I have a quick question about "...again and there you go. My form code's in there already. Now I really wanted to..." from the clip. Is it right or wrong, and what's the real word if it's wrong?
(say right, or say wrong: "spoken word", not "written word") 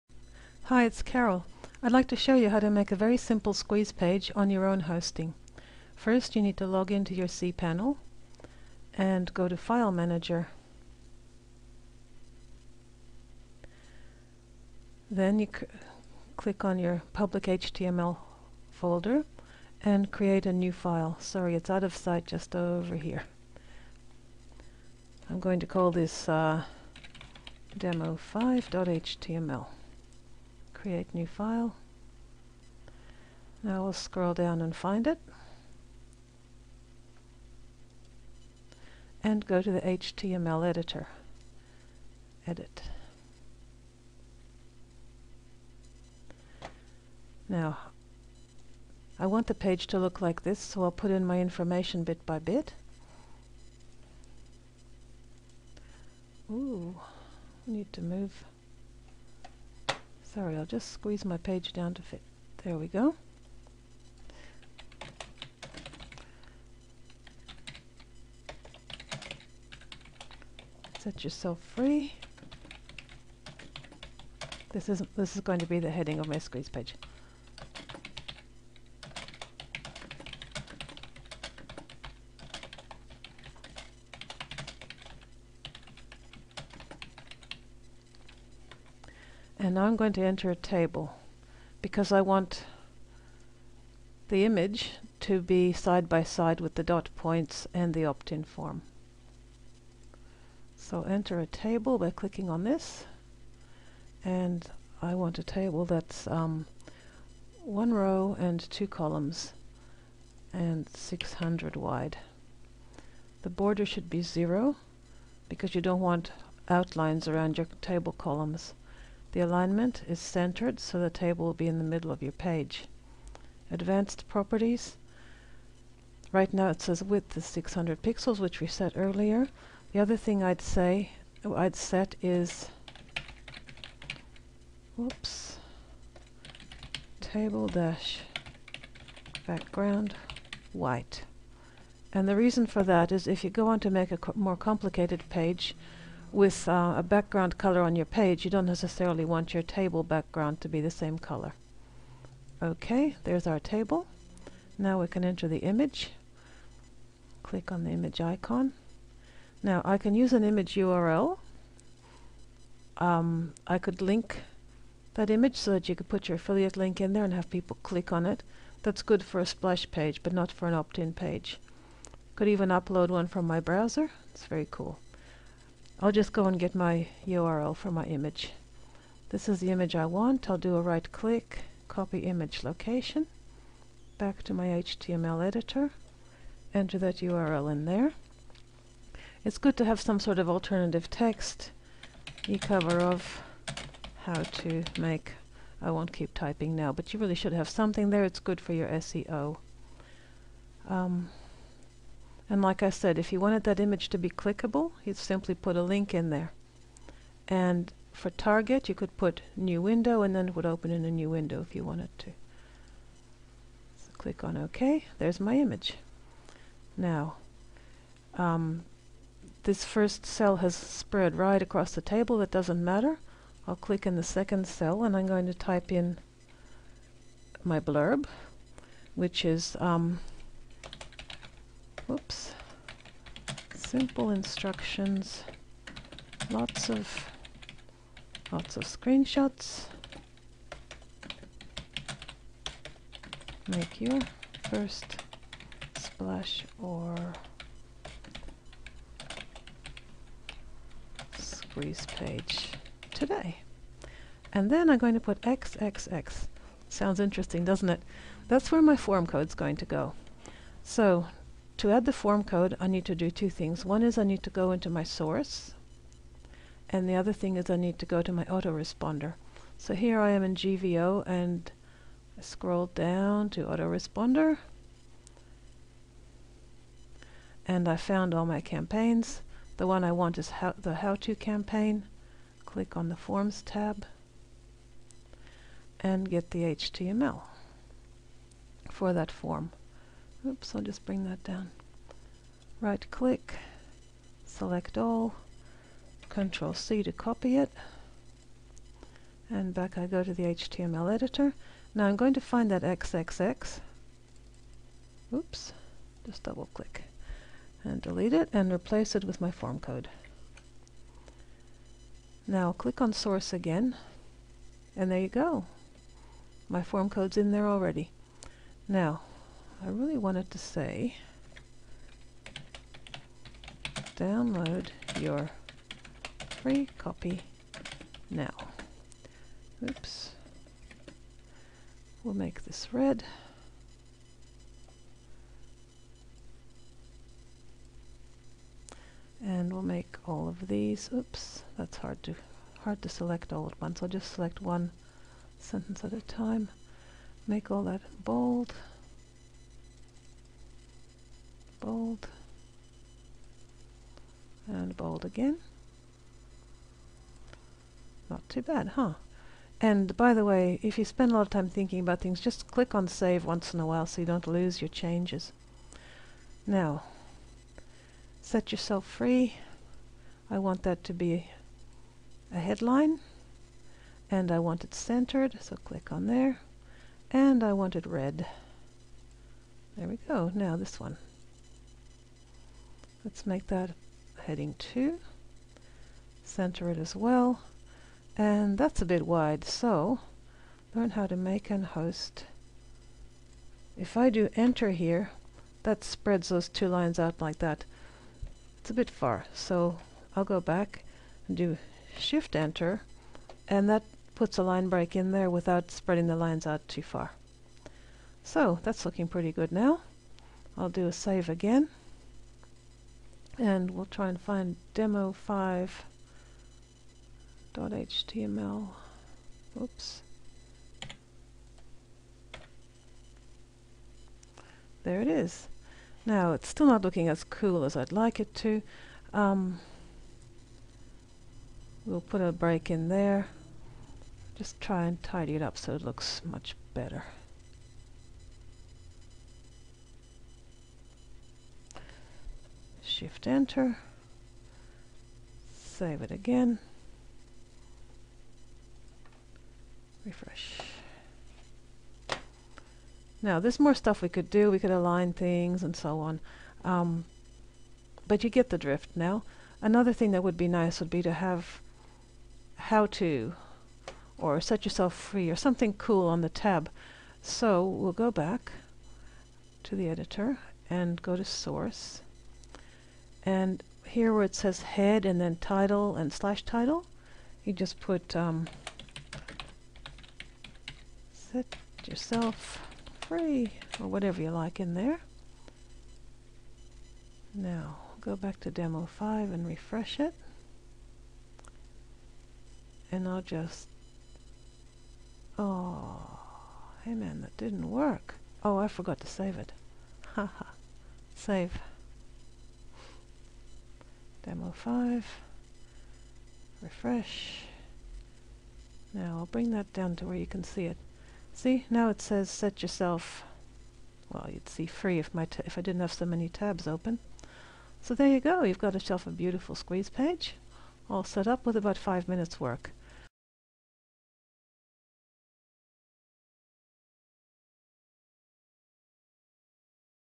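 right.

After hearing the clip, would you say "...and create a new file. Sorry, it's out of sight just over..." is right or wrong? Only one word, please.
right.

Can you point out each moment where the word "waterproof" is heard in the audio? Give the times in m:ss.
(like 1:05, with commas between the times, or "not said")
not said.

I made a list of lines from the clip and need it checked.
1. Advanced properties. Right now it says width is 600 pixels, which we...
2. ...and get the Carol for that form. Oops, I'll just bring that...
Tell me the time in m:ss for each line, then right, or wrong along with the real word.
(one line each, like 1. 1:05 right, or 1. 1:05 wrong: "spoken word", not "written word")
1. 2:03 right
2. 4:45 wrong: "HTML", not "Carol".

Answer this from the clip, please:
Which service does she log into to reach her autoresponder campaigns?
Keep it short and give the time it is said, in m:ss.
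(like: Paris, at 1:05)
GVO, at 4:30.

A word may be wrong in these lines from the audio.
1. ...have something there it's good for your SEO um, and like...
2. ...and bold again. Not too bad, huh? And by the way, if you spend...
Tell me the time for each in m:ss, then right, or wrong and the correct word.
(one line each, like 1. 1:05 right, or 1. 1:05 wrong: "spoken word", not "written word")
1. 3:17 right
2. 5:54 right.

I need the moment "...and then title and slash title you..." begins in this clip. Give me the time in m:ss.
7:55.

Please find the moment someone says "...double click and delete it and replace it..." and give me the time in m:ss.
5:06.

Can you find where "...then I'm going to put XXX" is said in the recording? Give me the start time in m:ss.
4:14.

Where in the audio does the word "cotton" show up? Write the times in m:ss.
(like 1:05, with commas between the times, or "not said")
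not said.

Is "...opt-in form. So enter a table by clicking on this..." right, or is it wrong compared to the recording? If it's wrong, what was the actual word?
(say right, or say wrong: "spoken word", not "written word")
right.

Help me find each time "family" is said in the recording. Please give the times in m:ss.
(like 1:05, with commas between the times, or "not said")
not said.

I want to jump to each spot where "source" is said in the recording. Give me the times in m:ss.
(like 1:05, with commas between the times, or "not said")
4:25, 5:13, 7:51.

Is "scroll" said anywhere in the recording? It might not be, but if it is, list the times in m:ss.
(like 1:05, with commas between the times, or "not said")
0:33, 4:32.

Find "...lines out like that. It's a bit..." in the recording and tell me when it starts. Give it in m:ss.
6:36.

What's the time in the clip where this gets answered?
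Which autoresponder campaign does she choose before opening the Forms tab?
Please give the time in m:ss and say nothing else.
4:40.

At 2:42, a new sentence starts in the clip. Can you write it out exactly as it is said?
Um, I could link that image so that you could put your affiliate link in there and have people click on it.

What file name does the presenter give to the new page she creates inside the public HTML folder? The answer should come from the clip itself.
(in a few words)
demo5.html.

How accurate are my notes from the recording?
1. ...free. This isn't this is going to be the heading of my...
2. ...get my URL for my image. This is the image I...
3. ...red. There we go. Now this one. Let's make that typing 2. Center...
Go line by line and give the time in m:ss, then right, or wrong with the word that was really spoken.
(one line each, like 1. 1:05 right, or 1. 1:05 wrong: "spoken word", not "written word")
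1. 1:11 right
2. 2:56 right
3. 6:18 wrong: "heading", not "typing".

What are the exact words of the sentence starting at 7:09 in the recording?
Um, we'll put a break in there.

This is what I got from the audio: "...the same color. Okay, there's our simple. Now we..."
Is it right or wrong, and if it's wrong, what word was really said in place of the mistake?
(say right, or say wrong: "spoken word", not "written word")
wrong: "table", not "simple".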